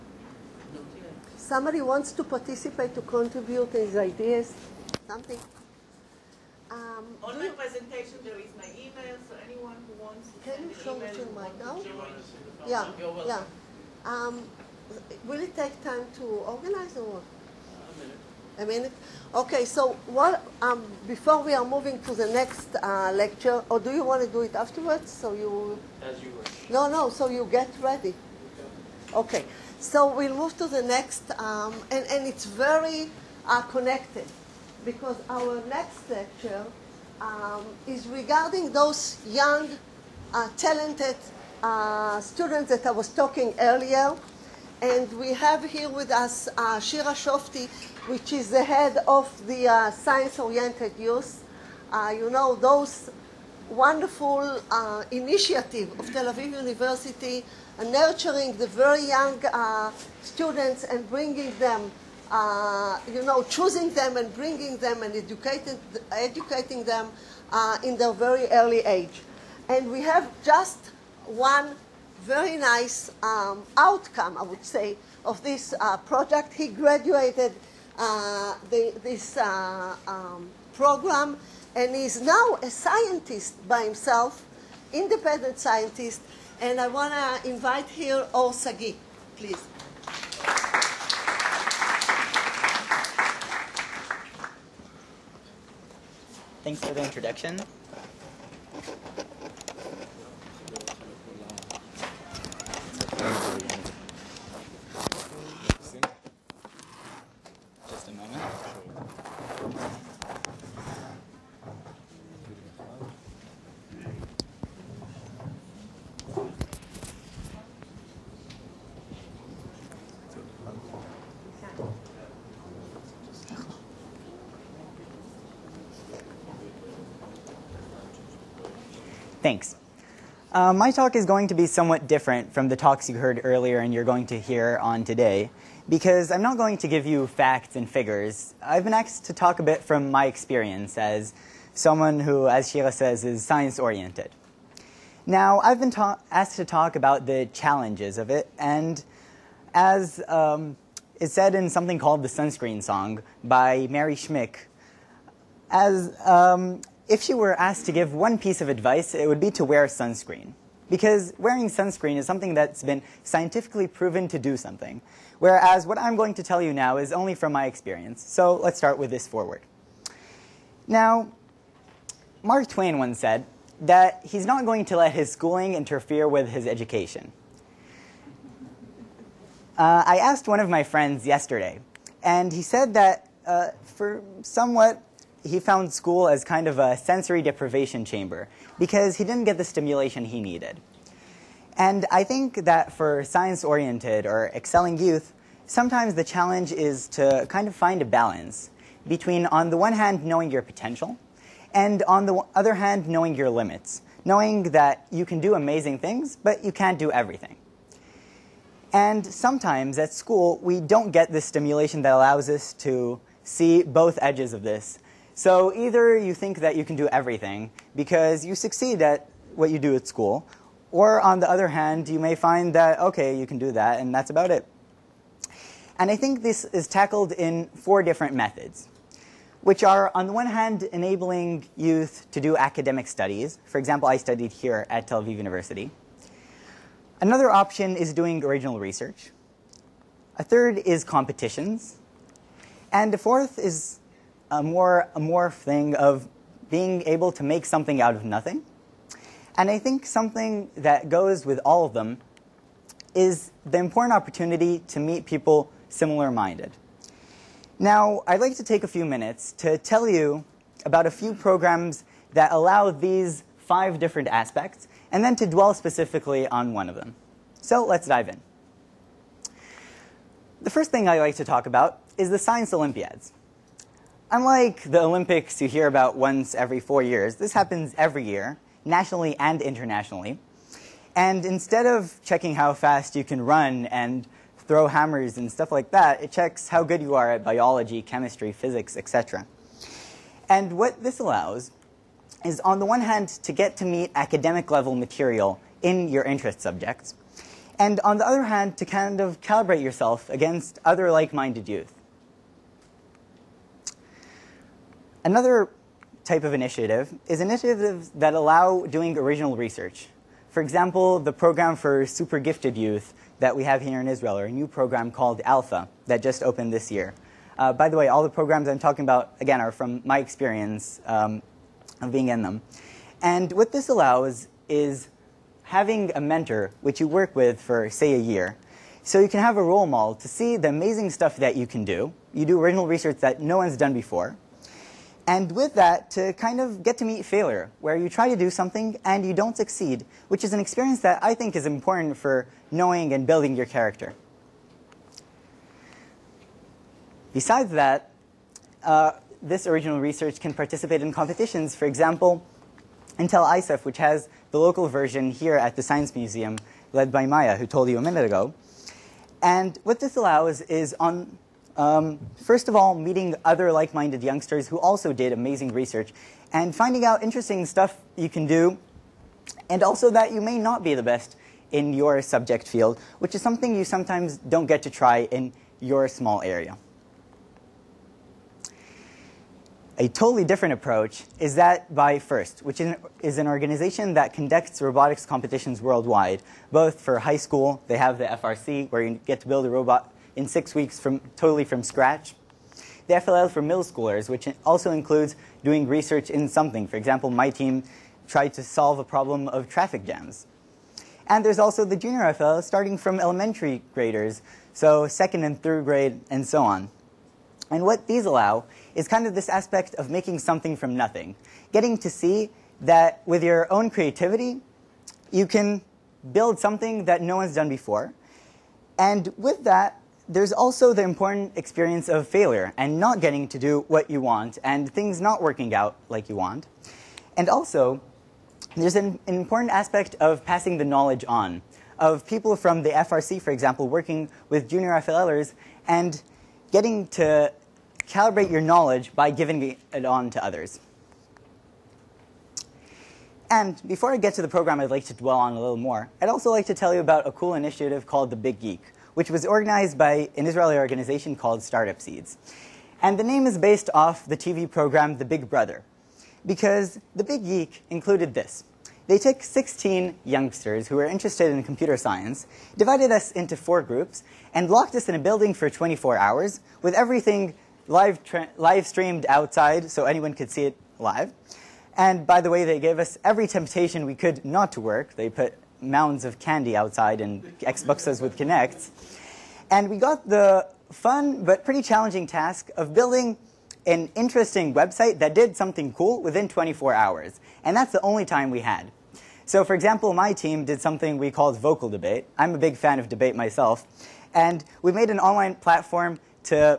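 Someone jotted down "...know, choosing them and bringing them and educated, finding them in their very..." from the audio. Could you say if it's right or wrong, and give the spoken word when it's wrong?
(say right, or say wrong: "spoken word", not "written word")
wrong: "educating", not "finding".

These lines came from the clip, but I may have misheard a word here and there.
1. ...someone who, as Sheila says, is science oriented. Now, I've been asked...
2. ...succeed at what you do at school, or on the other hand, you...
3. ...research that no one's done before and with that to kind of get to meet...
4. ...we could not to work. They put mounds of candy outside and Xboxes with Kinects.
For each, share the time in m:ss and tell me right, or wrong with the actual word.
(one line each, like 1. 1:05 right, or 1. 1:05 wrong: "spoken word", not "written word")
1. 2:21 right
2. 3:38 right
3. 5:32 right
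4. 7:54 right.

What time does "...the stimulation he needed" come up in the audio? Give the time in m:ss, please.
3:09.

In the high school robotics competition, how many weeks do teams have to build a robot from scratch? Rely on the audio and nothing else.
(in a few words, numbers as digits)
6.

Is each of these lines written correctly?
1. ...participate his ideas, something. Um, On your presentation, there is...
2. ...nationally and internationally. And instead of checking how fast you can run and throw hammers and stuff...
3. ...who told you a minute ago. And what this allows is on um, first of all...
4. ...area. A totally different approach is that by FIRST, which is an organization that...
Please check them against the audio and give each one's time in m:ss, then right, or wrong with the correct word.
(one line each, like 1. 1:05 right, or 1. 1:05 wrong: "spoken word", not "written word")
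1. 0:03 wrong: "contribute", not "participate"
2. 4:38 right
3. 5:57 right
4. 6:16 right.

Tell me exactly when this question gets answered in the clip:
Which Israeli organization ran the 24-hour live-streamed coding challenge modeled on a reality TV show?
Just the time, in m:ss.
7:31.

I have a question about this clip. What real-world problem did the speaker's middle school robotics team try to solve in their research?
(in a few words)
traffic jams.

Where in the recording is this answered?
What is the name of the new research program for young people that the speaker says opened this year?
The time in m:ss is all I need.
5:15.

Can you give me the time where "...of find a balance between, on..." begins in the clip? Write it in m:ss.
3:17.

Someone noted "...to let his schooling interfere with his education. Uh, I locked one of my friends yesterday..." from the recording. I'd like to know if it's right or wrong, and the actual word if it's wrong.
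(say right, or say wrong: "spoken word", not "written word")
wrong: "asked", not "locked".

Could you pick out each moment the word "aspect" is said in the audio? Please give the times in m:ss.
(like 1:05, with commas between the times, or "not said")
4:24, 6:49, 7:09.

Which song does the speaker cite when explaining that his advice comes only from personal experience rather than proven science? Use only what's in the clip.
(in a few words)
Sunscreen Song.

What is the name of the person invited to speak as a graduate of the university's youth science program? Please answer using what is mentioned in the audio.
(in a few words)
Or Sagi.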